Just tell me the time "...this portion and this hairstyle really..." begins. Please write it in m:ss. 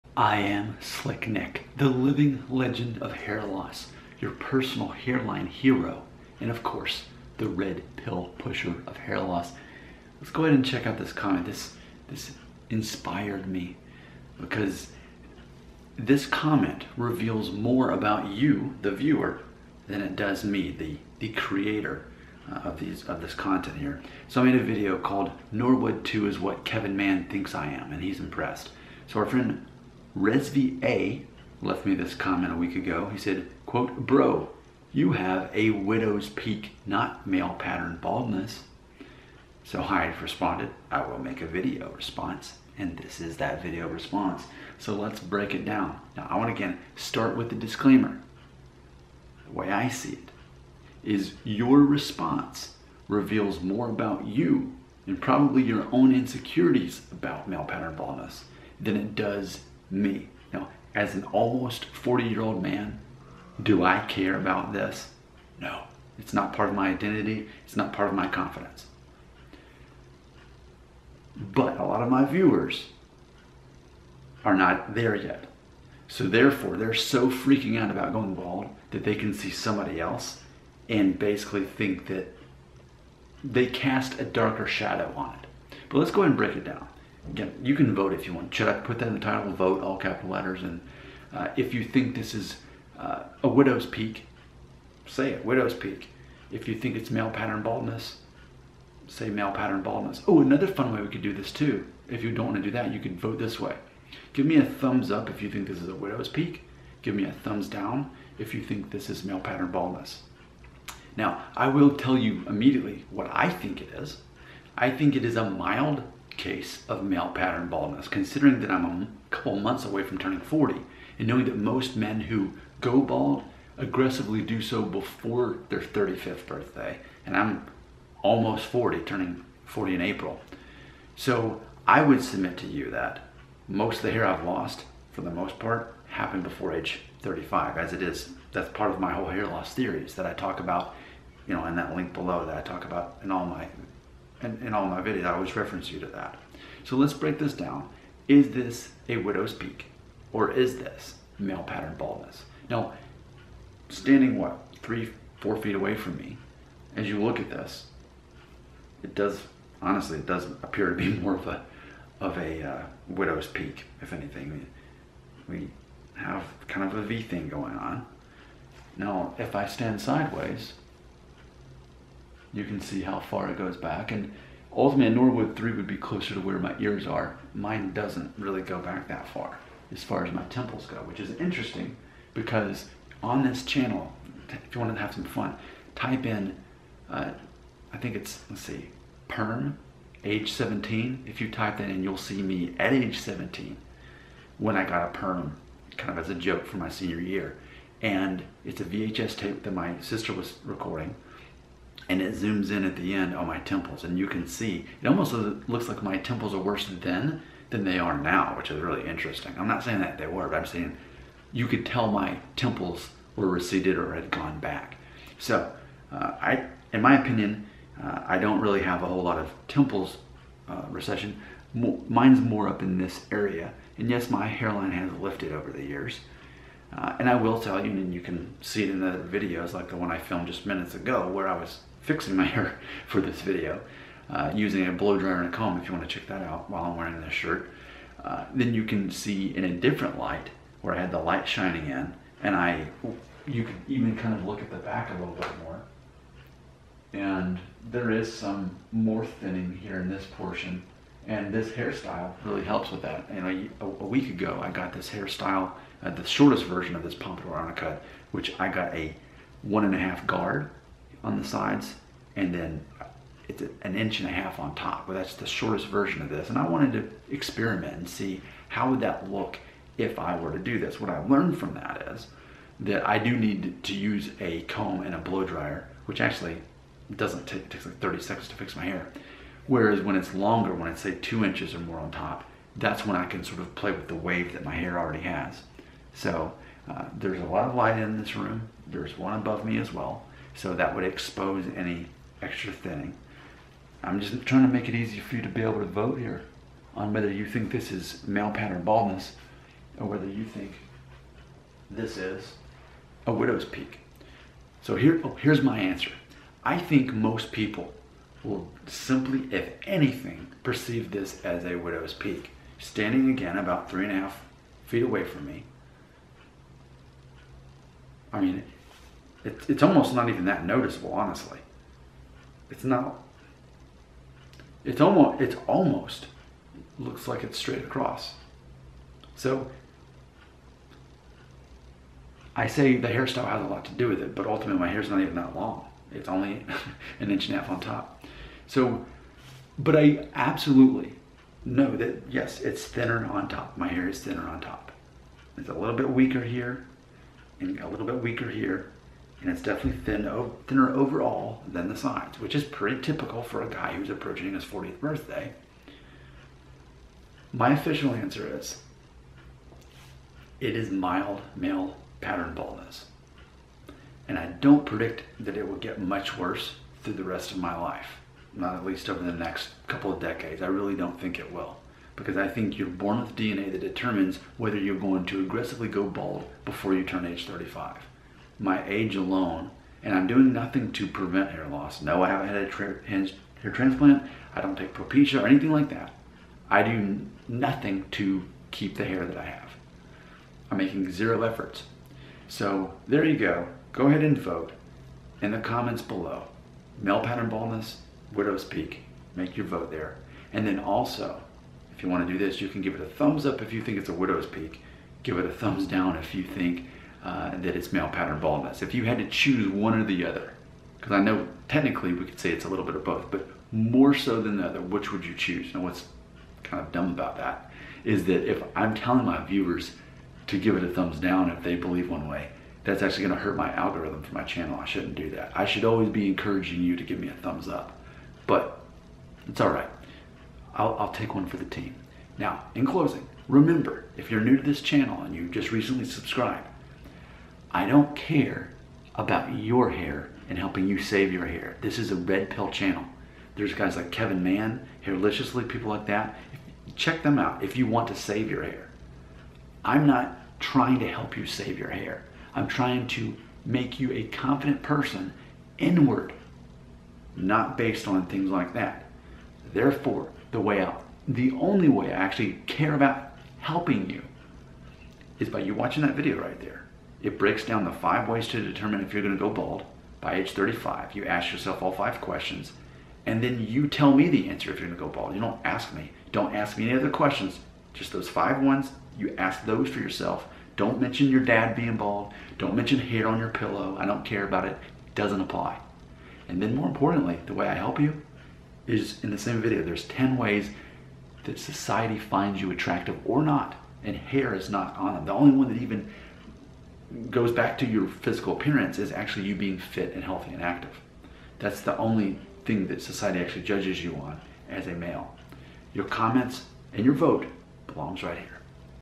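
4:10.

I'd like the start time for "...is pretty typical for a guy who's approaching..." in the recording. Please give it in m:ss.
5:52.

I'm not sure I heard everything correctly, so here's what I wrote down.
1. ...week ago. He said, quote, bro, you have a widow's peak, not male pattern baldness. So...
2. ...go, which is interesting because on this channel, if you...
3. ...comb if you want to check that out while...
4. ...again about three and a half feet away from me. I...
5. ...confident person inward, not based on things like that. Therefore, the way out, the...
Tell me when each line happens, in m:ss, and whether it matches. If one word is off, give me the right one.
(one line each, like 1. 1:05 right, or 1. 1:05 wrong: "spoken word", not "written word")
1. 0:32 right
2. 3:00 right
3. 3:55 right
4. 5:13 right
5. 7:34 right.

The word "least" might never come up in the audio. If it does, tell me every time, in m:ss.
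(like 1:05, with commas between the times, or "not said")
6:08.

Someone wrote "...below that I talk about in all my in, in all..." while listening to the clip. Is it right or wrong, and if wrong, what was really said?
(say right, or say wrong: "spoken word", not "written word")
right.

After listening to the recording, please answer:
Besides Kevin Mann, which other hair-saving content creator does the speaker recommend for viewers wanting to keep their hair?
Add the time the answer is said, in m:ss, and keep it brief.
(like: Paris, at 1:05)
Hairliciously, at 7:25.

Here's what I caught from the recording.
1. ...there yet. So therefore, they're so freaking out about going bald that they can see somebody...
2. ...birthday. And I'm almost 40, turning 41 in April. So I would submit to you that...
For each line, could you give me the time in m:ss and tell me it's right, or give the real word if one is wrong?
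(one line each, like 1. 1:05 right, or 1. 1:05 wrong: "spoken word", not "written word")
1. 1:14 right
2. 2:06 wrong: "40", not "41".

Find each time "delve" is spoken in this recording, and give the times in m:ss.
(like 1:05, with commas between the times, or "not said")
not said.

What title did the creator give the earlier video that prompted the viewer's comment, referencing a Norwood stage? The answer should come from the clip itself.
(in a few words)
Norwood 2 is what Kevin Mann thinks I am.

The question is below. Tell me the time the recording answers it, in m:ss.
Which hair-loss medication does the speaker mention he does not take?
6:24.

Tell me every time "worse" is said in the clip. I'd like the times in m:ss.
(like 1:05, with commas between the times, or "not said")
3:26, 6:06.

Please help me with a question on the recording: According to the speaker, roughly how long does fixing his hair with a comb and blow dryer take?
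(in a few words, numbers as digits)
30 seconds.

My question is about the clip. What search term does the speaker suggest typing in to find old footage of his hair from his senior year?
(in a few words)
perm, age 17.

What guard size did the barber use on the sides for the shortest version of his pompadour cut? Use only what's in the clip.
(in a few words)
one and a half guard.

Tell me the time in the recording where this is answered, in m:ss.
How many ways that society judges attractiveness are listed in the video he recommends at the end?
8:10.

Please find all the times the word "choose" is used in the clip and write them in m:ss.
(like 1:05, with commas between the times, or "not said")
6:49, 6:55.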